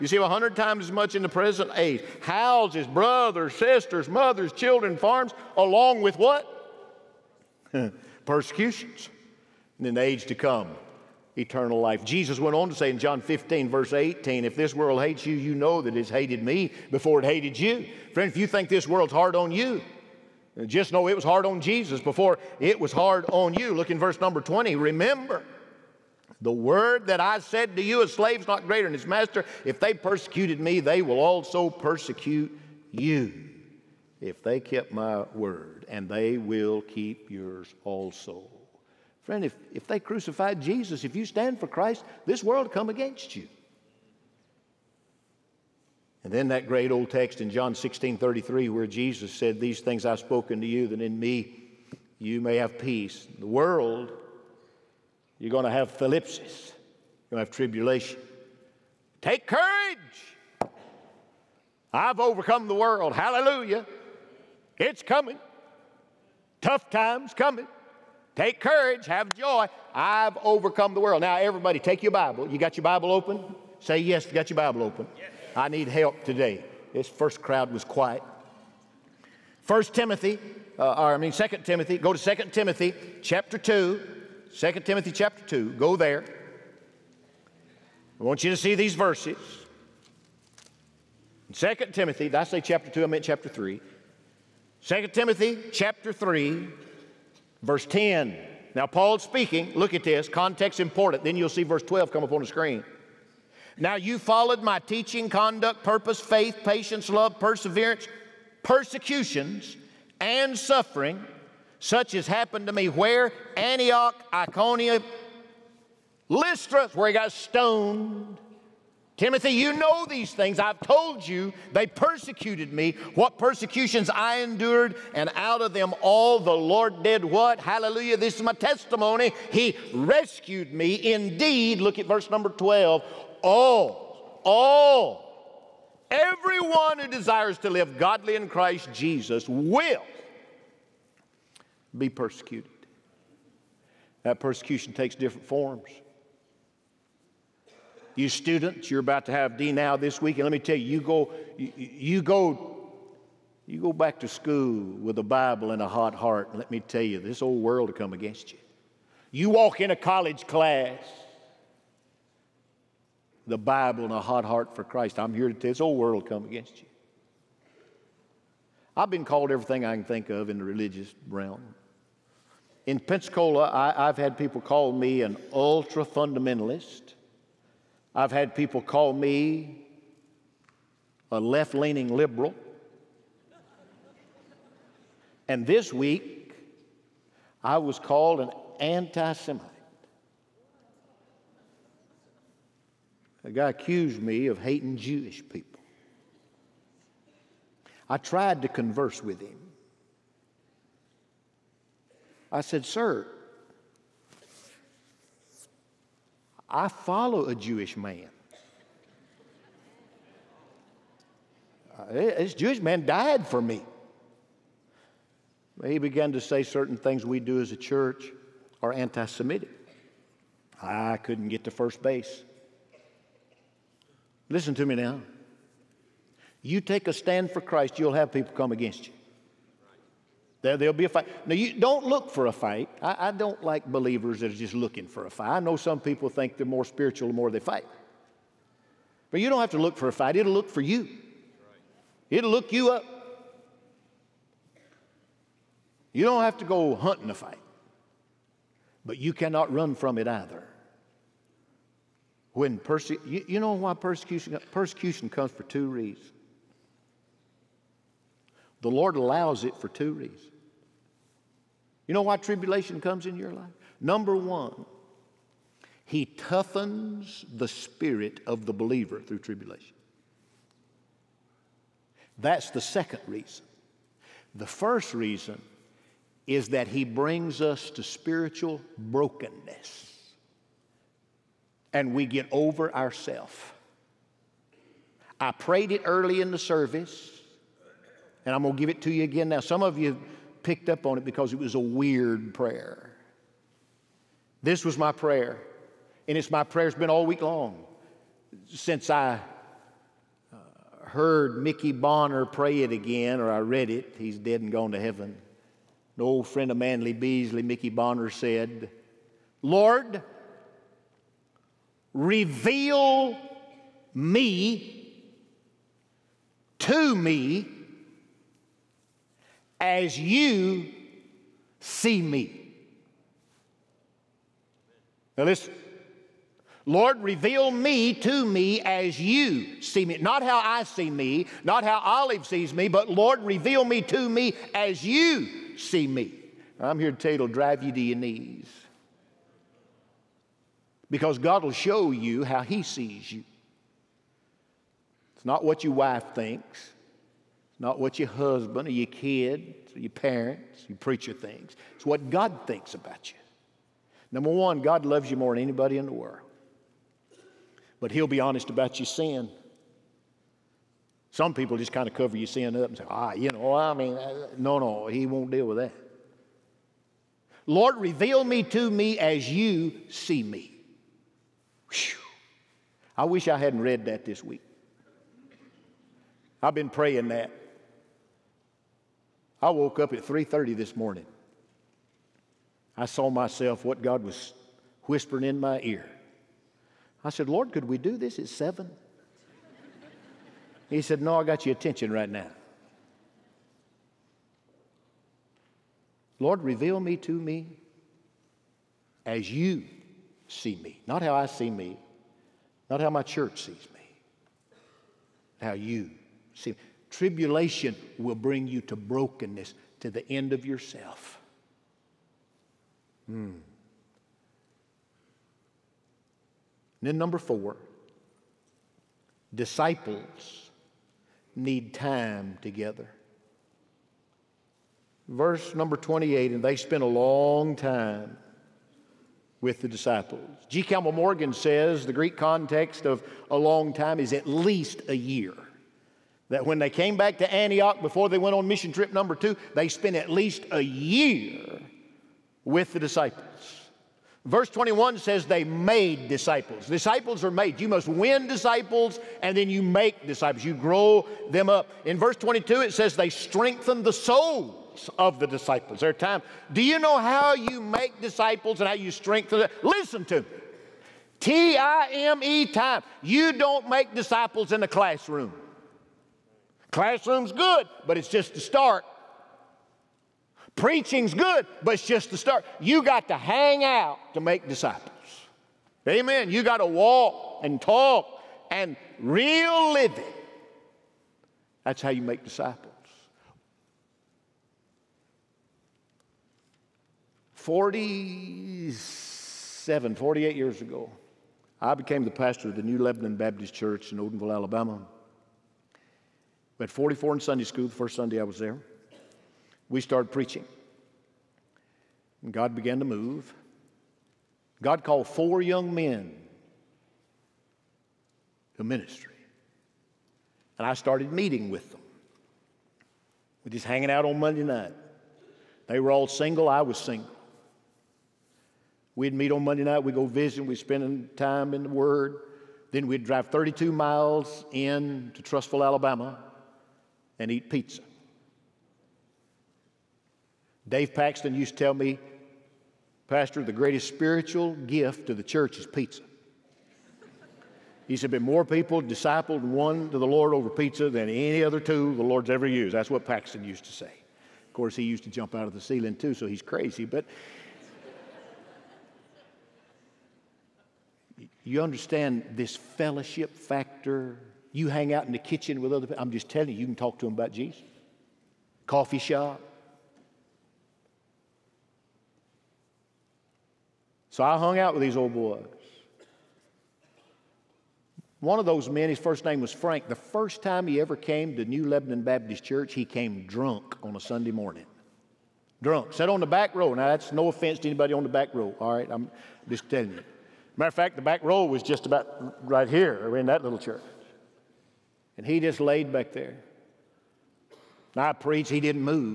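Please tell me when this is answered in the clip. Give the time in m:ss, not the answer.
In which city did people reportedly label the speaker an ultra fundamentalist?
2:52.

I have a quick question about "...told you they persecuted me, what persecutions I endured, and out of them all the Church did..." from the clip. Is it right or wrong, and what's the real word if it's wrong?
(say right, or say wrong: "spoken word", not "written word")
wrong: "Lord", not "Church".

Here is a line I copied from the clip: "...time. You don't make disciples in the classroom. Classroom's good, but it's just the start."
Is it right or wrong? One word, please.
right.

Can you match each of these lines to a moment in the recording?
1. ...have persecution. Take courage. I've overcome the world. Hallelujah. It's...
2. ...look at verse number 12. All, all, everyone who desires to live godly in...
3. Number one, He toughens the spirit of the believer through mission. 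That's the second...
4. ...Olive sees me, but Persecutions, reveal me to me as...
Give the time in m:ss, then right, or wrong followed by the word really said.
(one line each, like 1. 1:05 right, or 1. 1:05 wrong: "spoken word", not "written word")
1. 0:57 wrong: "tribulation", not "persecution"
2. 2:11 right
3. 4:23 wrong: "tribulation", not "mission"
4. 5:31 wrong: "Lord", not "Persecutions".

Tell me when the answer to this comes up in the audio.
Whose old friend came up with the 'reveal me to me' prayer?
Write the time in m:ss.
5:06.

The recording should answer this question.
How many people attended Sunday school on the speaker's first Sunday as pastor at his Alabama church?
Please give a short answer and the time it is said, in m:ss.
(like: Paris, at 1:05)
44, at 8:16.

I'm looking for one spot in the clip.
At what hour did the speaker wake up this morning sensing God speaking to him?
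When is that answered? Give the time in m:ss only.
6:20.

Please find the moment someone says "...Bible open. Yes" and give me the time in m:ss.
1:14.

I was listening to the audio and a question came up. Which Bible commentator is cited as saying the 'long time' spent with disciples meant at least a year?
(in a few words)
G. Campbell Morgan.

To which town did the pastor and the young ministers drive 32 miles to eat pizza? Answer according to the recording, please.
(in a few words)
Trussville, Alabama.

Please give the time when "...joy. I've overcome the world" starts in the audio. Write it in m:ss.
1:09.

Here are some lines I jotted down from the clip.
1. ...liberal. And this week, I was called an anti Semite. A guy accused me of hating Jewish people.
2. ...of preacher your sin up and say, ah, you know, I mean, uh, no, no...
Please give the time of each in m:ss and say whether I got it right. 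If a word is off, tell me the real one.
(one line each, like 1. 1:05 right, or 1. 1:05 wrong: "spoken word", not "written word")
1. 3:02 right
2. 6:02 wrong: "cover", not "preacher".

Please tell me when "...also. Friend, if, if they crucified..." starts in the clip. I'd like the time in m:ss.
0:37.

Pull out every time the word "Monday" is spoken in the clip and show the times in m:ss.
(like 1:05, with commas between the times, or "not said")
8:34, 8:39.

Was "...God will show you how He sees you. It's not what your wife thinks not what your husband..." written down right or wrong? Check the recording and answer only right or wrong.
right.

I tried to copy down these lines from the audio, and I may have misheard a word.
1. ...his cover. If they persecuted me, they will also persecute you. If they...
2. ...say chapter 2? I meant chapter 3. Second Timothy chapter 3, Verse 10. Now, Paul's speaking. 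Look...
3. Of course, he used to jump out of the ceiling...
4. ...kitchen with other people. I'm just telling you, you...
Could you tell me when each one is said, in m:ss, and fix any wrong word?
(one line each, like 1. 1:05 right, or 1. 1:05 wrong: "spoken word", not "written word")
1. 0:28 wrong: "master", not "cover"
2. 1:32 right
3. 9:04 right
4. 9:15 right.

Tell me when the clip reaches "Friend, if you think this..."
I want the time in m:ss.
0:18.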